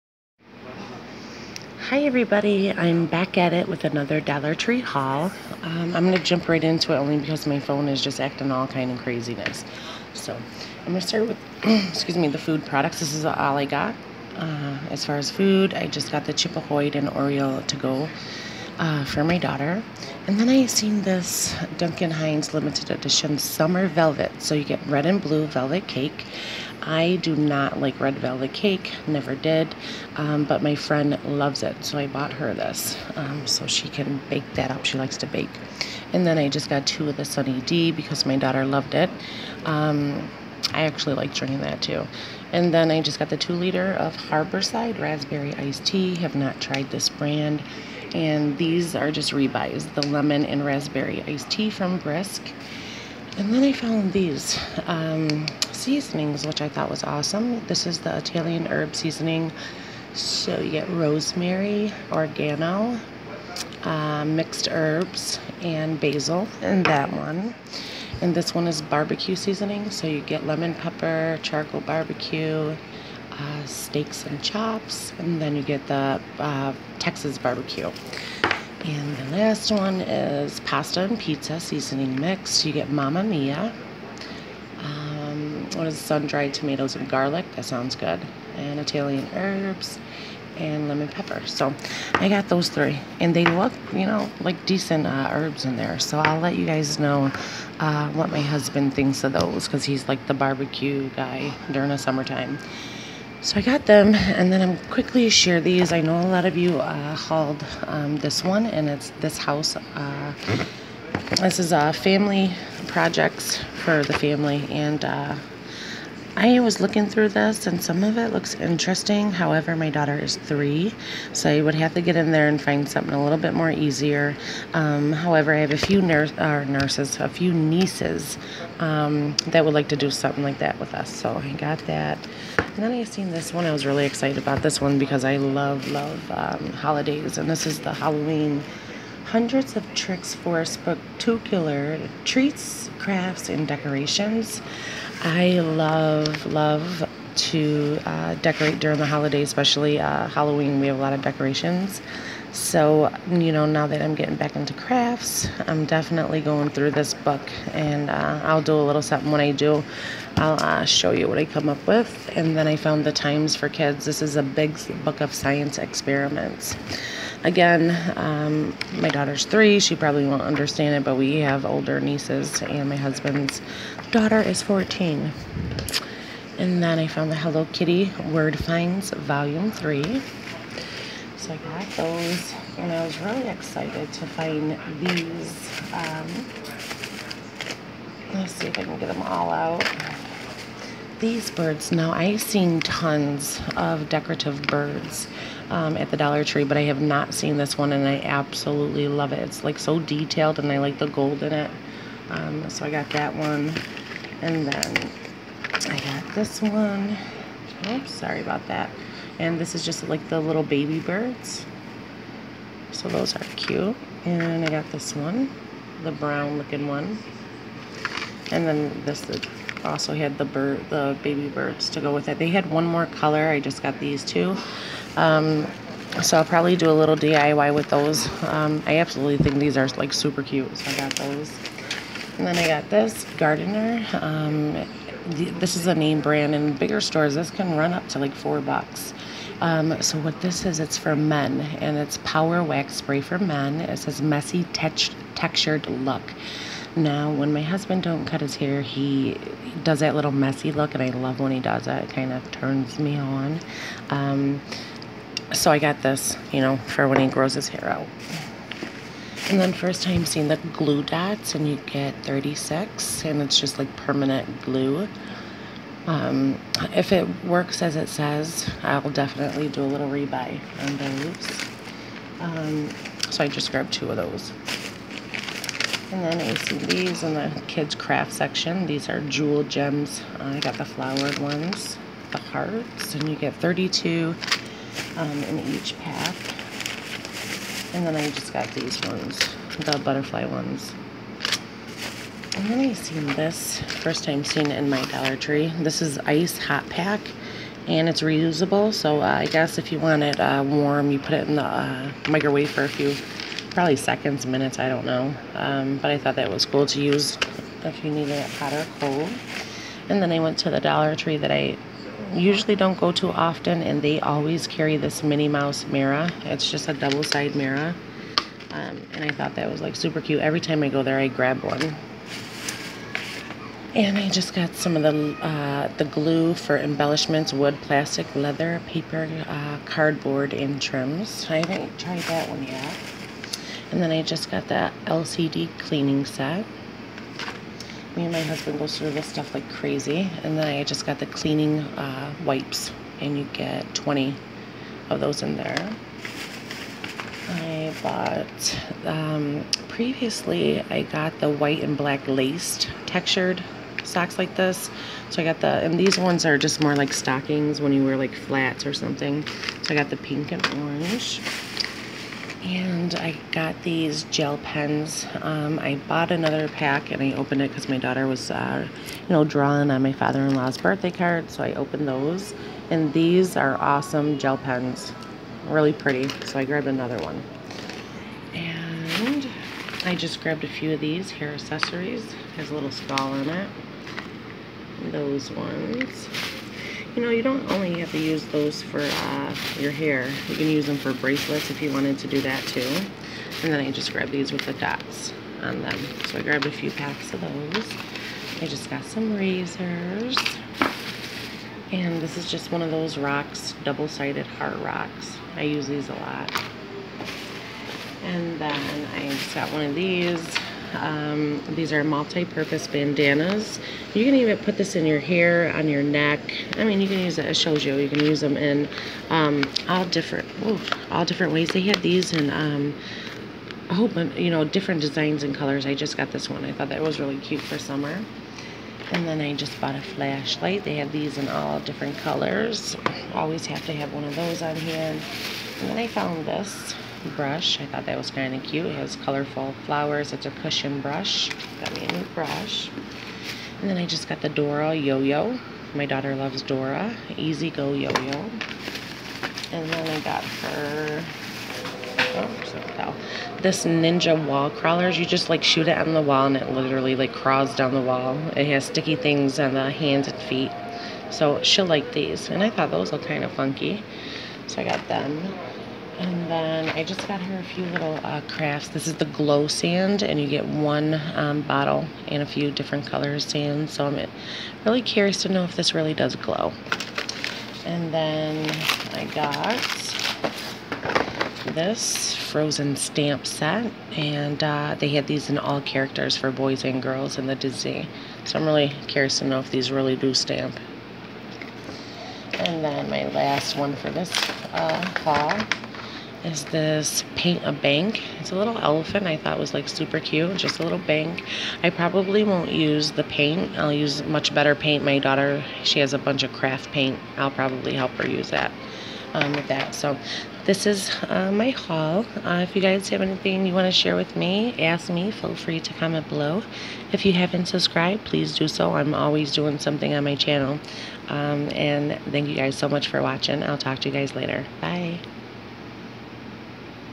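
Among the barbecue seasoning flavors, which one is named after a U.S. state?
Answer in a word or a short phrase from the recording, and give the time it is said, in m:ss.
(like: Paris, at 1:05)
Texas barbecue, at 1:16.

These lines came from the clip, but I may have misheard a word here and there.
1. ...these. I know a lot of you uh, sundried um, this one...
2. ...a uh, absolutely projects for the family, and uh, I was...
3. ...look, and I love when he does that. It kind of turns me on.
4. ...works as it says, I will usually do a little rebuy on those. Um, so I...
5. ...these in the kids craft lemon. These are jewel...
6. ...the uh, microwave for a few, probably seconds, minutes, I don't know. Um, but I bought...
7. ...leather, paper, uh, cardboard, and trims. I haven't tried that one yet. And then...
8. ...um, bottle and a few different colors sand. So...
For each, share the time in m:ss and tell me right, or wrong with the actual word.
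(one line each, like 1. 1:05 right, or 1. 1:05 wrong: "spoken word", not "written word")
1. 1:45 wrong: "hauled", not "sundried"
2. 1:51 wrong: "family", not "absolutely"
3. 4:10 right
4. 4:27 wrong: "definitely", not "usually"
5. 4:36 wrong: "section", not "lemon"
6. 5:01 wrong: "thought", not "bought"
7. 5:28 right
8. 7:51 right.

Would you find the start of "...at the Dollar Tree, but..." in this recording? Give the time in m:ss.
3:15.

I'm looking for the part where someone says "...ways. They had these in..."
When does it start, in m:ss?
7:01.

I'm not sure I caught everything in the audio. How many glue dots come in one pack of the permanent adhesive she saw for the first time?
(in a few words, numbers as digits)
36.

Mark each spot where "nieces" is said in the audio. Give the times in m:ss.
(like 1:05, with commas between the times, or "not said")
2:07, 2:51.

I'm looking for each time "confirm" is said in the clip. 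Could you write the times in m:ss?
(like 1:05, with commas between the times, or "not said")
not said.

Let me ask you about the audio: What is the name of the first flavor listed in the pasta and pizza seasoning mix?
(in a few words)
Mamma Mia.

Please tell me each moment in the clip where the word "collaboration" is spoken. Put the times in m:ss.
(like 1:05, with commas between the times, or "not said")
not said.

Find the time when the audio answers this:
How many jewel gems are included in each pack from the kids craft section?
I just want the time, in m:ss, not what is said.
4:43.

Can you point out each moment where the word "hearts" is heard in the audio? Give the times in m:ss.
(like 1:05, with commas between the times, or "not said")
4:42, 6:44.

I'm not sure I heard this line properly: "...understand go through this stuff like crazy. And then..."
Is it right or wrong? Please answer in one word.
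wrong.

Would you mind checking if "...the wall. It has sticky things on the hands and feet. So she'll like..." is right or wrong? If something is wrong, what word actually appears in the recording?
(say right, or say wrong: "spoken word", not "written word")
right.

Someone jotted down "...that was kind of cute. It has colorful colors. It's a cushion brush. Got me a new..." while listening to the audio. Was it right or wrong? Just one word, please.
wrong.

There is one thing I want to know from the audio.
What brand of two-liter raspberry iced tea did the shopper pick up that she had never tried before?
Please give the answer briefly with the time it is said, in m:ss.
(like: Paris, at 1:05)
Harborside, at 0:44.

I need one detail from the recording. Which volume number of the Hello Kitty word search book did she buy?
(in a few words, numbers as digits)
3.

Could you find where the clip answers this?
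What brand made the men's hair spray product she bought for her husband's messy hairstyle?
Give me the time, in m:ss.
3:53.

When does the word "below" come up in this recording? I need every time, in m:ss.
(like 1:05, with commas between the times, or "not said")
8:36.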